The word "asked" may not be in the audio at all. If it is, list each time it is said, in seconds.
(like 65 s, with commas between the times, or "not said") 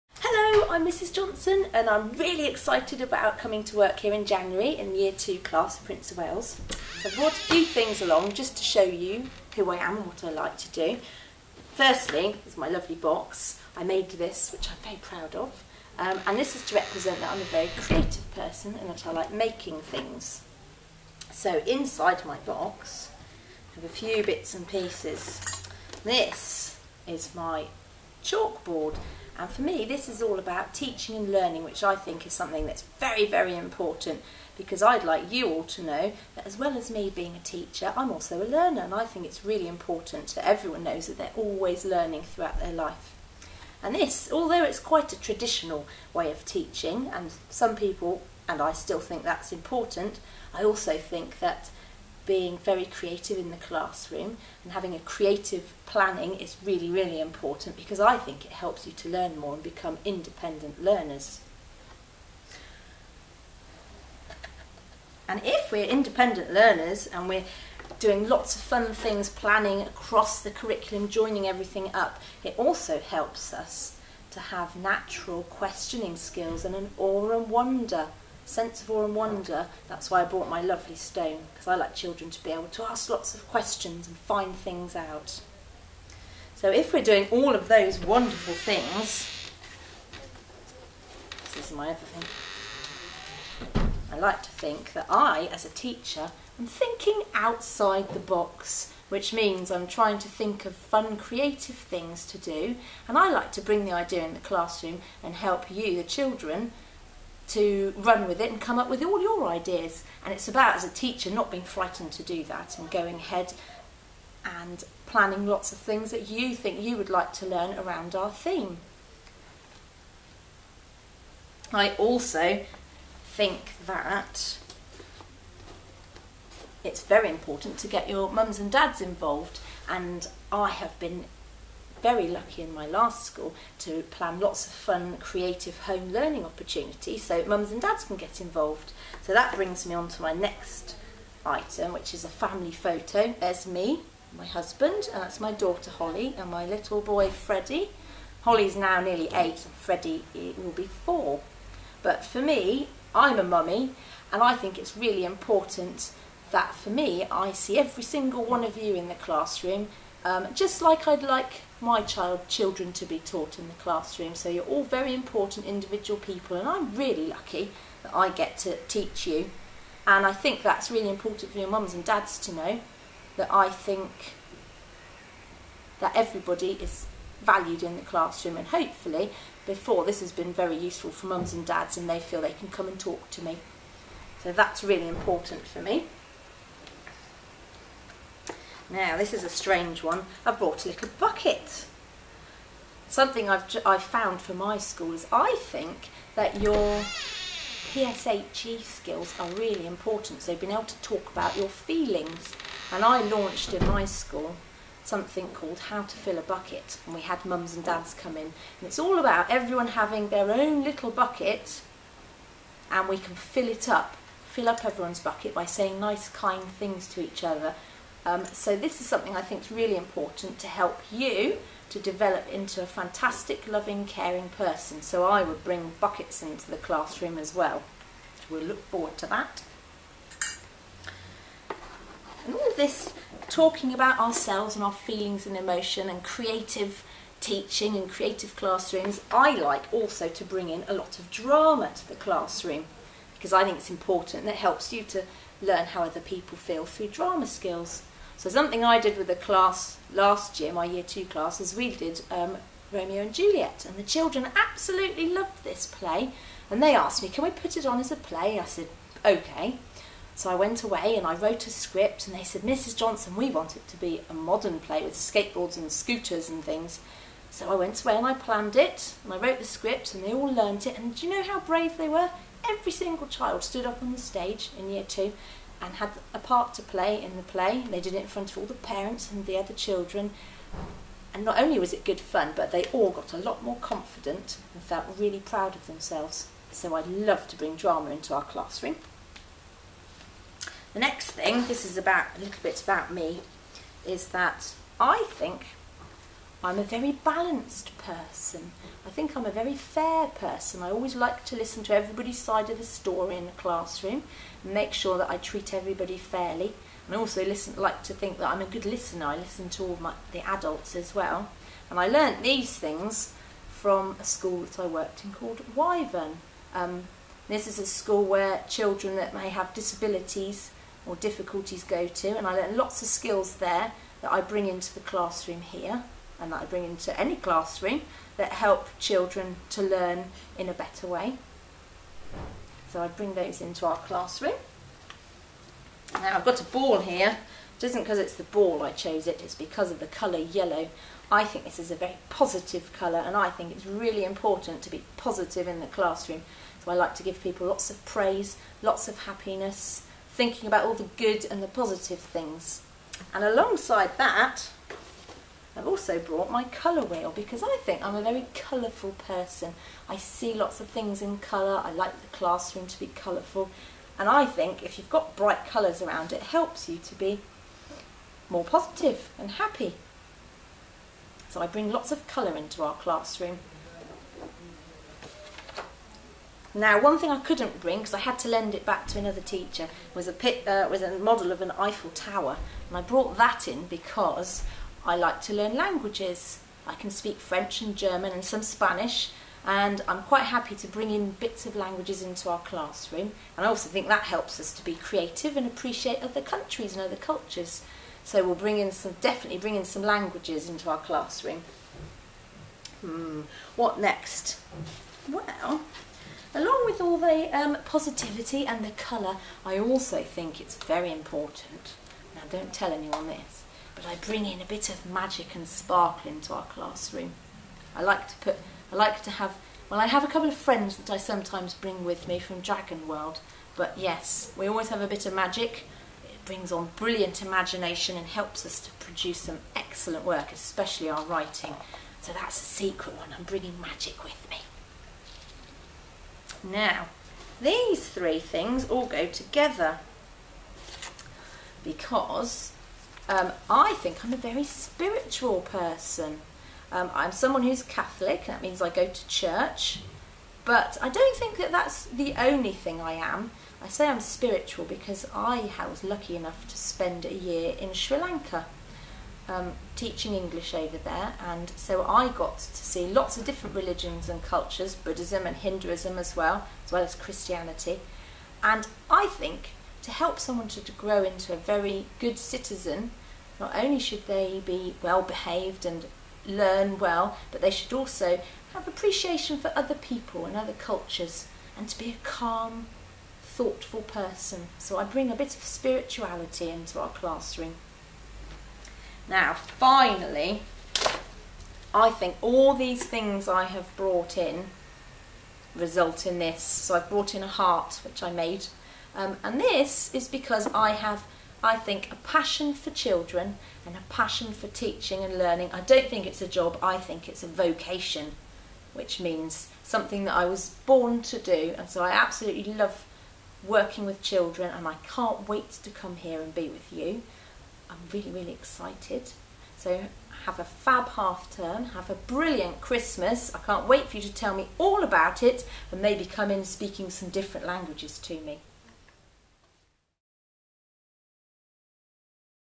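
256 s.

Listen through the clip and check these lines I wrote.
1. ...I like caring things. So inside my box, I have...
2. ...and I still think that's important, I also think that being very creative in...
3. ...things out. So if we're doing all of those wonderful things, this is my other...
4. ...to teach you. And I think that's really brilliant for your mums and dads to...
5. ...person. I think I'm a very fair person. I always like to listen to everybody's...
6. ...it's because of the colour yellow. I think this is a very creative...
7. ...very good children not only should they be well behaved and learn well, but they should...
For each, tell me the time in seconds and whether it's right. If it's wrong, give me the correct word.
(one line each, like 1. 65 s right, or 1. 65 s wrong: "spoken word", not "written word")
1. 19 s wrong: "making", not "caring"
2. 48 s right
3. 84 s right
4. 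168 s wrong: "important", not "brilliant"
5. 297 s right
6. 339 s wrong: "positive", not "creative"
7. 471 s wrong: "citizen", not "children".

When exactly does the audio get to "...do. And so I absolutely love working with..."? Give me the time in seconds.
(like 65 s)
511 s.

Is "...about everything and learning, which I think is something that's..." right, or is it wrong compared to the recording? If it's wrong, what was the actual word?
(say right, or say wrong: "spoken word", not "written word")
wrong: "teaching", not "everything".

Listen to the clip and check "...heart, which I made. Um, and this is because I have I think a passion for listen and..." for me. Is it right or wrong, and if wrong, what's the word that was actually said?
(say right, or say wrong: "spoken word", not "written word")
wrong: "children", not "listen".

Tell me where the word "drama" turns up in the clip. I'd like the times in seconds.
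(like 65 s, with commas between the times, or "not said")
241 s, 247 s, 287 s.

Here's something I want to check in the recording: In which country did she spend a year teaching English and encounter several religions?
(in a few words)
Sri Lanka.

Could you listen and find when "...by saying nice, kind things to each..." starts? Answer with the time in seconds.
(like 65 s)
215 s.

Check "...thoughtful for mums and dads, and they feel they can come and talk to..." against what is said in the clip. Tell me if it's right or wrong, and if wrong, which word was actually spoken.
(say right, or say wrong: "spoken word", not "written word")
wrong: "useful", not "thoughtful".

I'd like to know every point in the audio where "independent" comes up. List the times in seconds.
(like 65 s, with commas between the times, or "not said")
60 s, 65 s.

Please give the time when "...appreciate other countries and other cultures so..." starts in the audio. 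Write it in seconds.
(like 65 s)
395 s.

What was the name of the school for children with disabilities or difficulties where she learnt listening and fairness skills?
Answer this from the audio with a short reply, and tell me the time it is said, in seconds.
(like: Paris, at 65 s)
Wyvern, at 315 s.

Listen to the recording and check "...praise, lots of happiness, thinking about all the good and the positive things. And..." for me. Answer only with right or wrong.
right.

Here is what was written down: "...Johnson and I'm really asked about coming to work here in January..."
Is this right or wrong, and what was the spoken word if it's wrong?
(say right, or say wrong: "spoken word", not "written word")
wrong: "excited", not "asked".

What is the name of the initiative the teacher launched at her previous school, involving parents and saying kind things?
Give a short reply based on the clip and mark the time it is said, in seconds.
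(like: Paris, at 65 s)
How to Fill a Bucket, at 205 s.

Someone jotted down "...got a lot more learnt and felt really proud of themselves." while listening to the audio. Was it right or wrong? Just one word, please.
wrong.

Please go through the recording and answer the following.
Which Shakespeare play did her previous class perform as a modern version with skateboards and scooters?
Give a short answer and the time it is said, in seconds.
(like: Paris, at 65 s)
Romeo and Juliet, at 252 s.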